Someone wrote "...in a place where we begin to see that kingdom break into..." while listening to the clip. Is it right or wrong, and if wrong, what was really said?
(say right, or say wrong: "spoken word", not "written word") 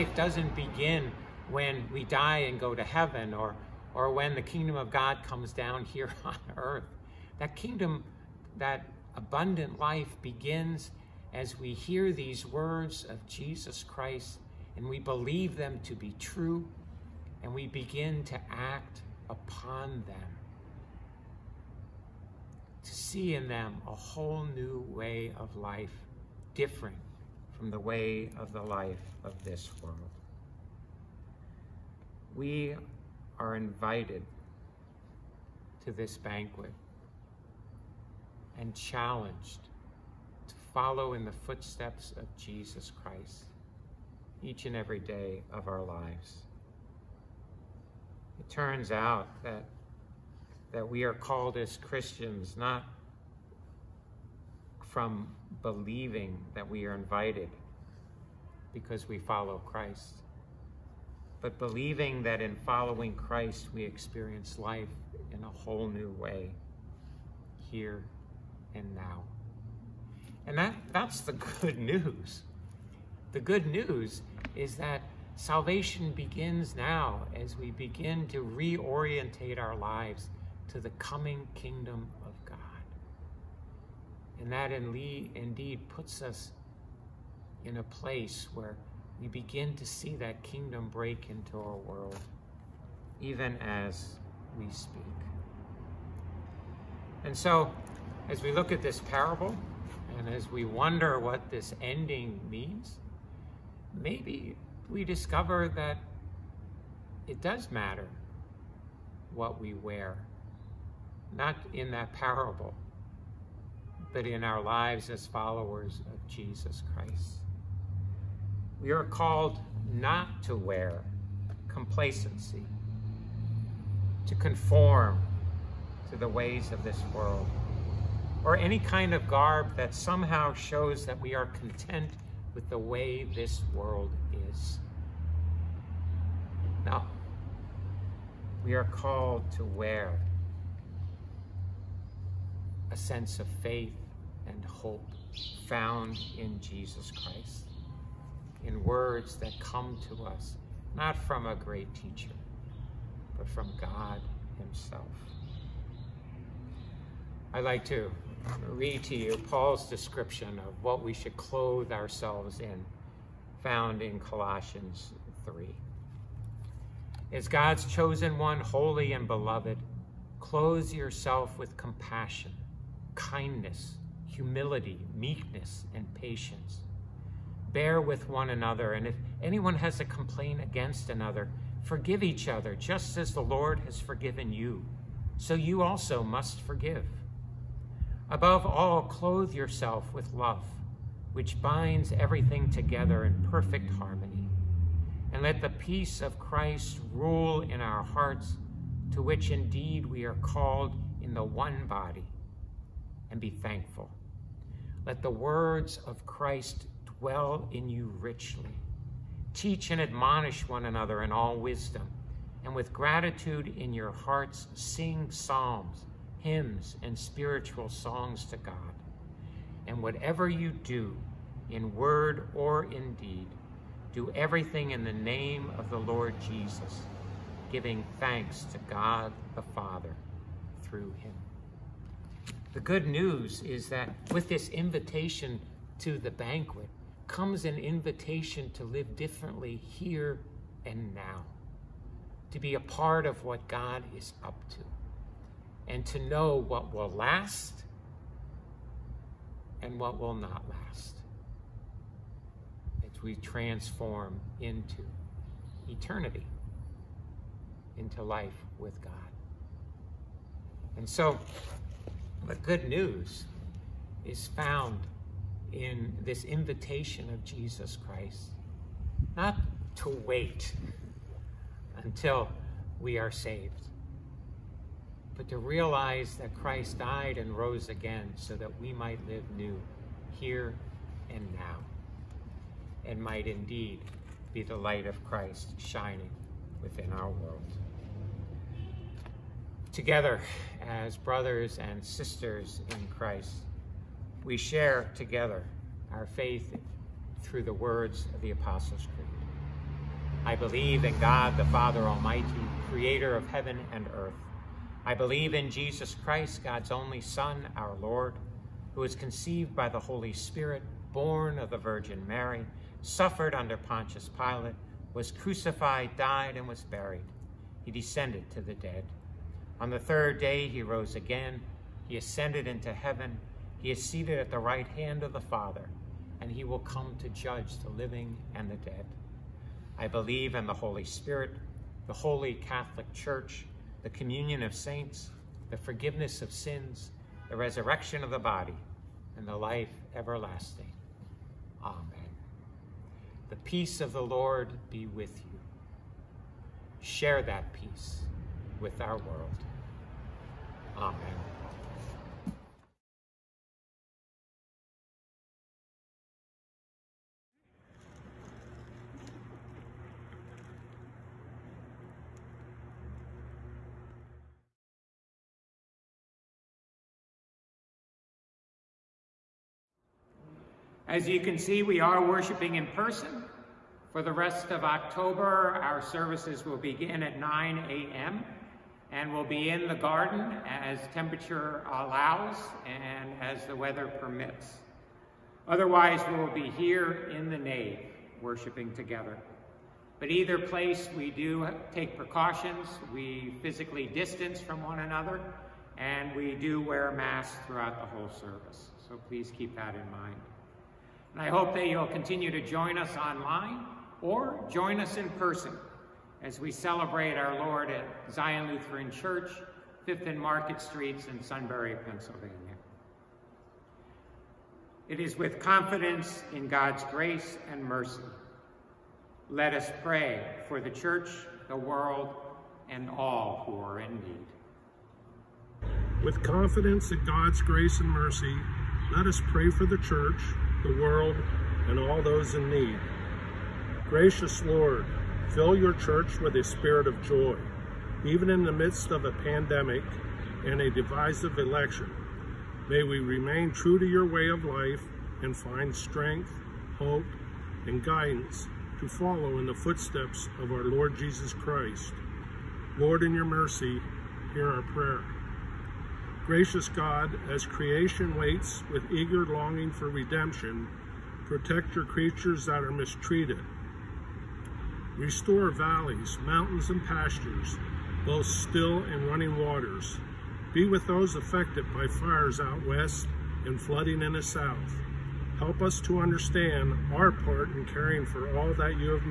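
right.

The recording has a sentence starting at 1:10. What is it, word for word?
And that, that's the good news.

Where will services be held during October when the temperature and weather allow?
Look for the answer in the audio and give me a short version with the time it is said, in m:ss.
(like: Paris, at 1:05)
In the garden, at 6:19.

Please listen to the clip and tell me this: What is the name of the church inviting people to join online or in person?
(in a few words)
Zion Lutheran Church.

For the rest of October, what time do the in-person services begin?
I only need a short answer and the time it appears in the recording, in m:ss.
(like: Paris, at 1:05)
9 a.m., at 6:17.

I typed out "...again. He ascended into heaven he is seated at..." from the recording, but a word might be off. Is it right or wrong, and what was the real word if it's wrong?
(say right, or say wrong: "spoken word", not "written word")
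right.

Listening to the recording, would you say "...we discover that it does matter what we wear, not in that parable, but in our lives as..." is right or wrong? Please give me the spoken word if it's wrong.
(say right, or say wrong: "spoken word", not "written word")
right.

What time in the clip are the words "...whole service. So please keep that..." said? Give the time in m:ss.
6:38.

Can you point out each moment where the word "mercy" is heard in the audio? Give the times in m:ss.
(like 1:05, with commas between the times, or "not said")
6:57, 7:08, 7:33.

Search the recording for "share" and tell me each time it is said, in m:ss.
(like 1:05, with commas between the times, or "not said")
4:54, 5:47.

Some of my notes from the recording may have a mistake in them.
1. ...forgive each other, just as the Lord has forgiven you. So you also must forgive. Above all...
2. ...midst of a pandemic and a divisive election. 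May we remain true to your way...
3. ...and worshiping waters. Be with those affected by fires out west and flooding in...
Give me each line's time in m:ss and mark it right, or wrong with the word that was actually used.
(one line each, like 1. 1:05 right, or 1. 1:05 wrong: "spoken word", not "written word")
1. 3:01 right
2. 7:18 right
3. 7:49 wrong: "running", not "worshiping".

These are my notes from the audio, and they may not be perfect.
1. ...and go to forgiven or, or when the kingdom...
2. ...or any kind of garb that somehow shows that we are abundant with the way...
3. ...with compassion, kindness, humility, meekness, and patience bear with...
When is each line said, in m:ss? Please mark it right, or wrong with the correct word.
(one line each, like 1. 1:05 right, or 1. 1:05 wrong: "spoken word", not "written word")
1. 0:02 wrong: "heaven", not "forgiven"
2. 2:08 wrong: "content", not "abundant"
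3. 2:51 right.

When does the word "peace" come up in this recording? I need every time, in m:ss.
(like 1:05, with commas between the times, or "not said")
3:15, 5:43, 5:47.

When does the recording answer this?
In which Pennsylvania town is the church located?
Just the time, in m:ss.
6:51.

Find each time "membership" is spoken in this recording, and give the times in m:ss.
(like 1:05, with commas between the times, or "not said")
not said.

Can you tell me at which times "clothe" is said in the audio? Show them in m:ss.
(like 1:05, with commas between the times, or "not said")
2:41, 2:50, 3:09.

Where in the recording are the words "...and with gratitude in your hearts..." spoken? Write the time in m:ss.
3:32.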